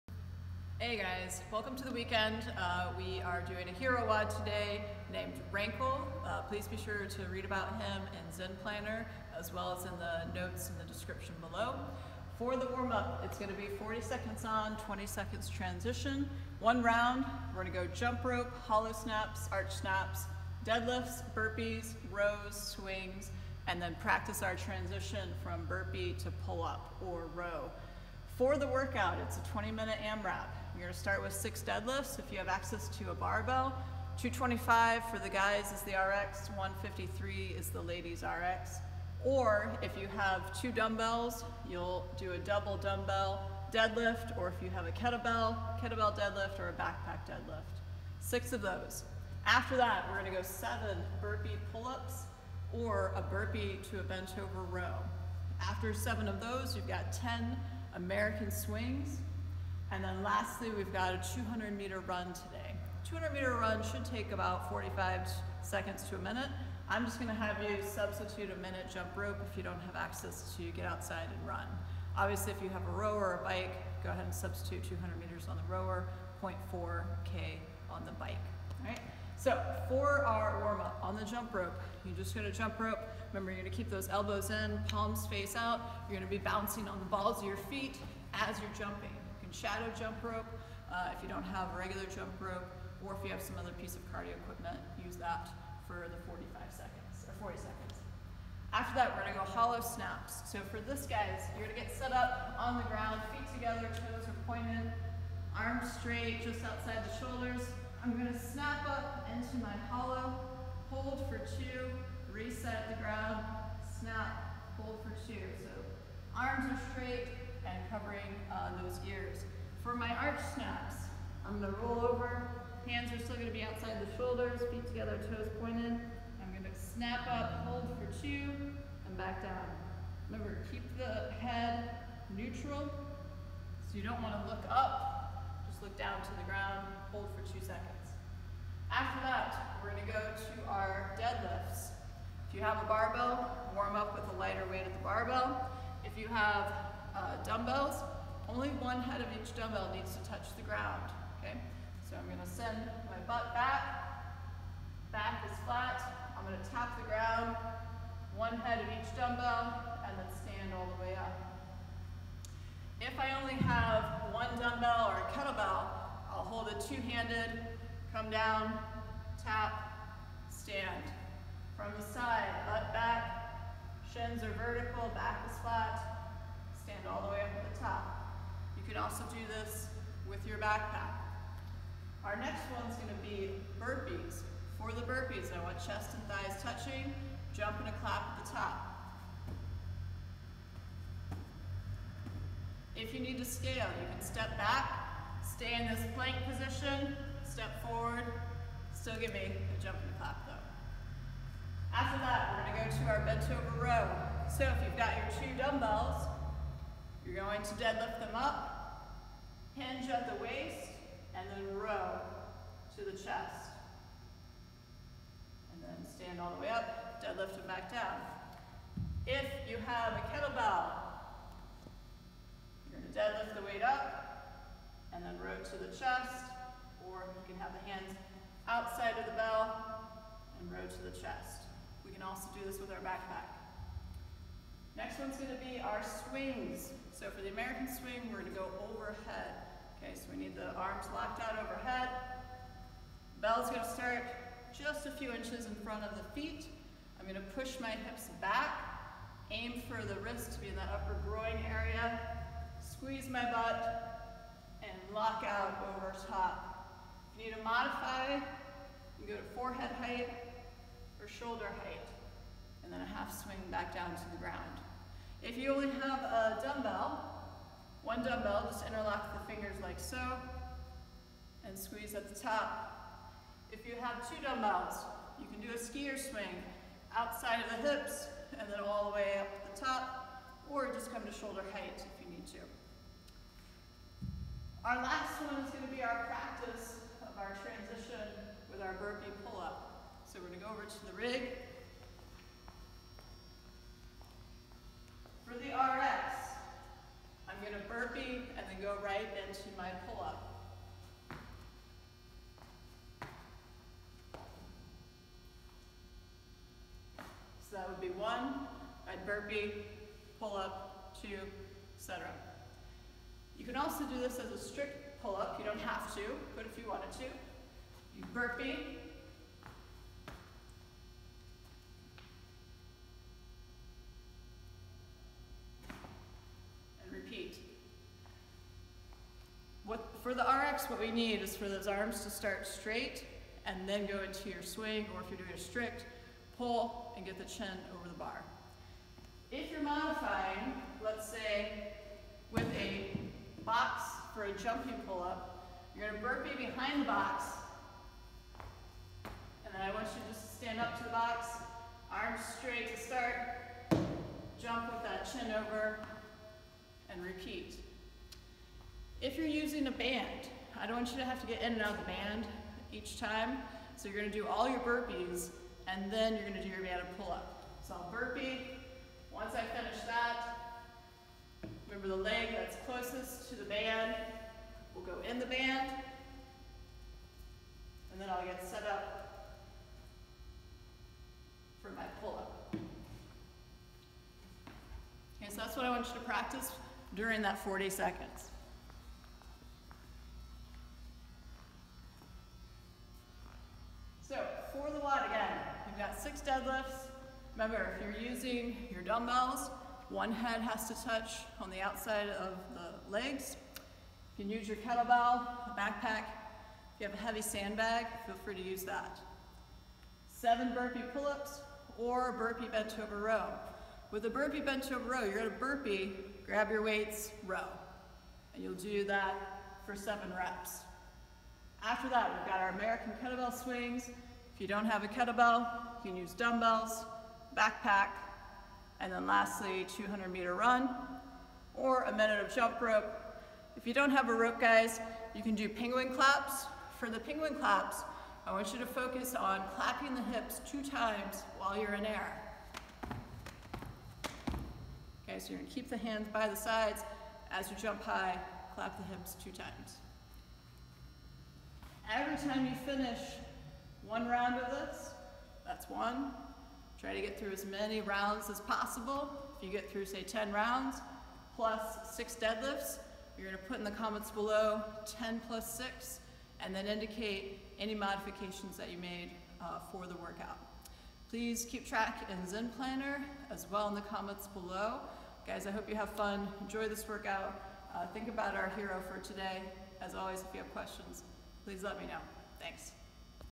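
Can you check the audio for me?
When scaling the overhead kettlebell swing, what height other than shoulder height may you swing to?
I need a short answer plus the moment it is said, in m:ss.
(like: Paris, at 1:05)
forehead height, at 4:19.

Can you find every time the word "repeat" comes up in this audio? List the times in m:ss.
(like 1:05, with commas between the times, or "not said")
5:27, 5:57.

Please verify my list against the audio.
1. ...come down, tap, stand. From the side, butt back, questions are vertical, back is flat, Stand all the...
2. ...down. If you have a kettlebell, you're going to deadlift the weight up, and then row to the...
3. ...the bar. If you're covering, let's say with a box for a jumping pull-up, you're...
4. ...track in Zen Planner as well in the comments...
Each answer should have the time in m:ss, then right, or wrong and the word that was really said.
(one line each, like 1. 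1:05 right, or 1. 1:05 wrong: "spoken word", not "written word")
1. 2:48 wrong: "shins", not "questions"
2. 3:37 right
3. 5:38 wrong: "modifying", not "covering"
4. 7:51 right.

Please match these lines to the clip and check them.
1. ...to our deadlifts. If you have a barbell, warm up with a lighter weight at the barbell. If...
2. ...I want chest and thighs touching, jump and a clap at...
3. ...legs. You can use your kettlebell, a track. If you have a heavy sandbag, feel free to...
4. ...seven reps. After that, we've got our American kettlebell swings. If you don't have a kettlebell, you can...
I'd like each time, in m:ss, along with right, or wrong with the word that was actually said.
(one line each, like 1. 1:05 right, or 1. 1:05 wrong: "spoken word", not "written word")
1. 2:20 right
2. 3:05 right
3. 6:43 wrong: "backpack", not "track"
4. 6:59 right.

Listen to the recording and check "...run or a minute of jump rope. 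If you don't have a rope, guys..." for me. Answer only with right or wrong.
right.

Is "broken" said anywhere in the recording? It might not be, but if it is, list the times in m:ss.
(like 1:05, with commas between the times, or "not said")
not said.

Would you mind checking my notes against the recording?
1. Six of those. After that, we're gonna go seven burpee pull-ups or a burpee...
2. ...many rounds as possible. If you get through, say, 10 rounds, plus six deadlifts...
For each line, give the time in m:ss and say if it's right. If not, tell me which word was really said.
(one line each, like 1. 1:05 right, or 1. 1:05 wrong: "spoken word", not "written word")
1. 0:48 right
2. 7:37 right.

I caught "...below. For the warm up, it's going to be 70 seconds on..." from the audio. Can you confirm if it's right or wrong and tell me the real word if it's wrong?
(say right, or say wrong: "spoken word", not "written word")
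wrong: "40", not "70".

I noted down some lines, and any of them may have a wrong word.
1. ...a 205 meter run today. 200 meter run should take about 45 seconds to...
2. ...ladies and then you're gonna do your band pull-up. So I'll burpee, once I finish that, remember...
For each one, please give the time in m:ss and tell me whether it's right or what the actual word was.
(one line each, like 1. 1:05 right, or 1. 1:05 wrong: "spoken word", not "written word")
1. 1:01 wrong: "200", not "205"
2. 6:04 wrong: "burpees", not "ladies".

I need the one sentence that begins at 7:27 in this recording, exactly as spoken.
As you jump high, clap the hips two times.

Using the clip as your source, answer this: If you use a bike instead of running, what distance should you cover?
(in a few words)
0.4K.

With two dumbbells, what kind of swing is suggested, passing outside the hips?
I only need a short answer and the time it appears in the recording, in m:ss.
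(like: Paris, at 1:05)
skier swing, at 4:35.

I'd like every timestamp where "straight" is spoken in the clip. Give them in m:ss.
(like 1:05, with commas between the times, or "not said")
1:45, 1:56, 5:32, 5:52.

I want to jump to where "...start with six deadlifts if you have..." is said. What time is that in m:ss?
0:30.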